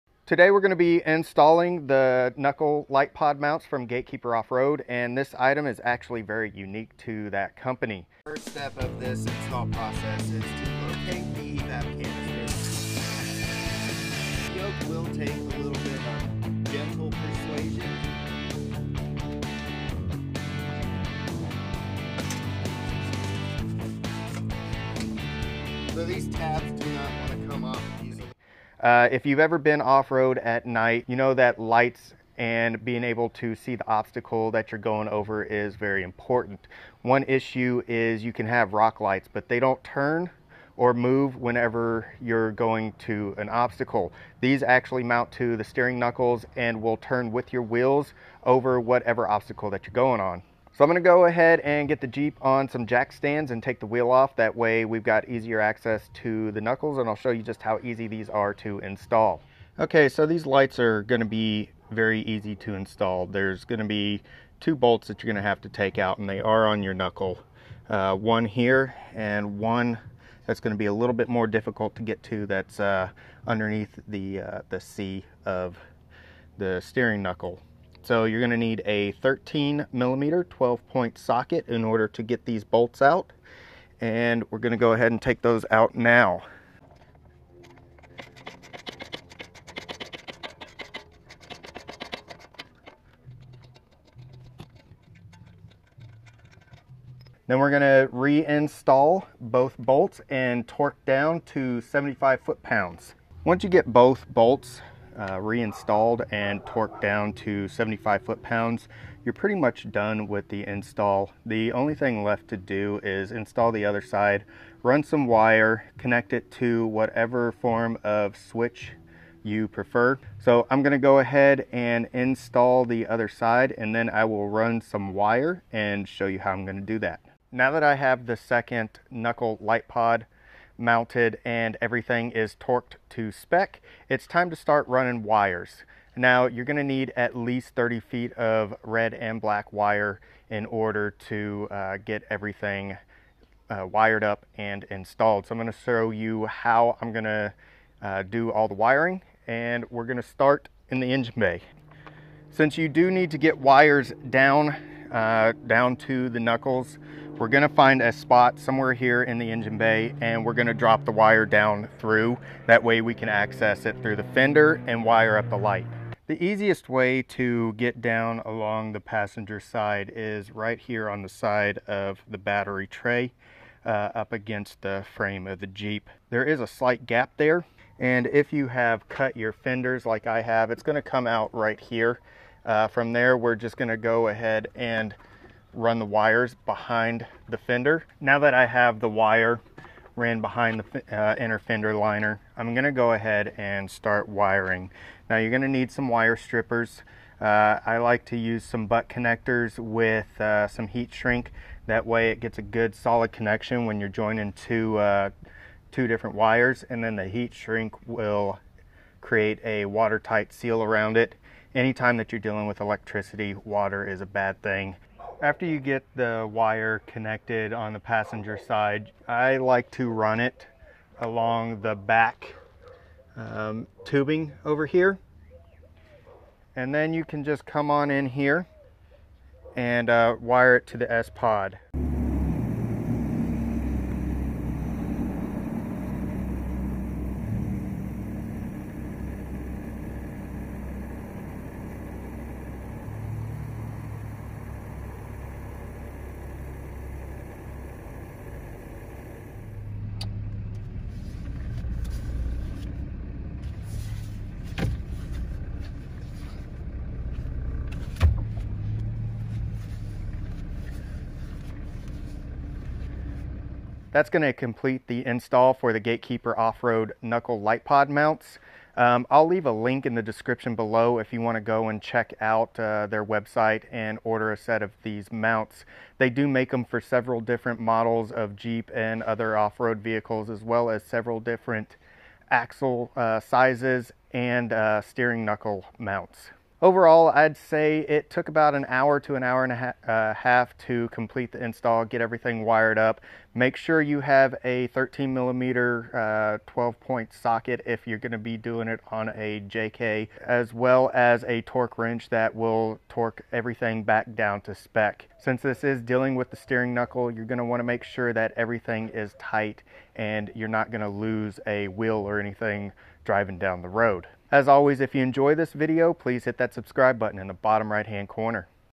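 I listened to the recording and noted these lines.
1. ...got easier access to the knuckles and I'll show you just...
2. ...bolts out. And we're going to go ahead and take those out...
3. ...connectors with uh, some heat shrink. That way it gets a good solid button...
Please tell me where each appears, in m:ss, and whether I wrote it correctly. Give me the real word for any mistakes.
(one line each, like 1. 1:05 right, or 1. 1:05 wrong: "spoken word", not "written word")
1. 0:55 right
2. 1:22 right
3. 3:19 wrong: "connection", not "button".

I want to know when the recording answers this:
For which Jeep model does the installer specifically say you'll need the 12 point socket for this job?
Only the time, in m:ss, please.
4:59.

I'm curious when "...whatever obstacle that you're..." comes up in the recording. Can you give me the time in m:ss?
0:48.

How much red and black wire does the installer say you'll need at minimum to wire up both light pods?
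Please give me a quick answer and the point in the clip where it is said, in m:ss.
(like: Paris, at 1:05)
30 feet, at 2:17.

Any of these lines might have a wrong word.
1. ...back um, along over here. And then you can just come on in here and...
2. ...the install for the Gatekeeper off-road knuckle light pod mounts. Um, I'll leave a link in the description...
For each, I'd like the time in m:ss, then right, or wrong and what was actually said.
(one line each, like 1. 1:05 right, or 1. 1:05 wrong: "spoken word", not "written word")
1. 3:41 wrong: "tubing", not "along"
2. 4:25 right.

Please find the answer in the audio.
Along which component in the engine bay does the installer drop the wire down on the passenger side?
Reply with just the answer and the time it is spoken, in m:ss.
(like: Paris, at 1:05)
battery tray, at 2:52.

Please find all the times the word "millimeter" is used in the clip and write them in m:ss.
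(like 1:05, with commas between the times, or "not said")
1:19, 4:55.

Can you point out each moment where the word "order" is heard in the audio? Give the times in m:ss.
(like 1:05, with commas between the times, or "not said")
1:21, 2:20, 4:34.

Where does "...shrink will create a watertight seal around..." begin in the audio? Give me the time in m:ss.
3:27.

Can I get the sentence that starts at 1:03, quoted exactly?
There's gonna be two bolts that you're gonna have to take out and they are on your knuckle.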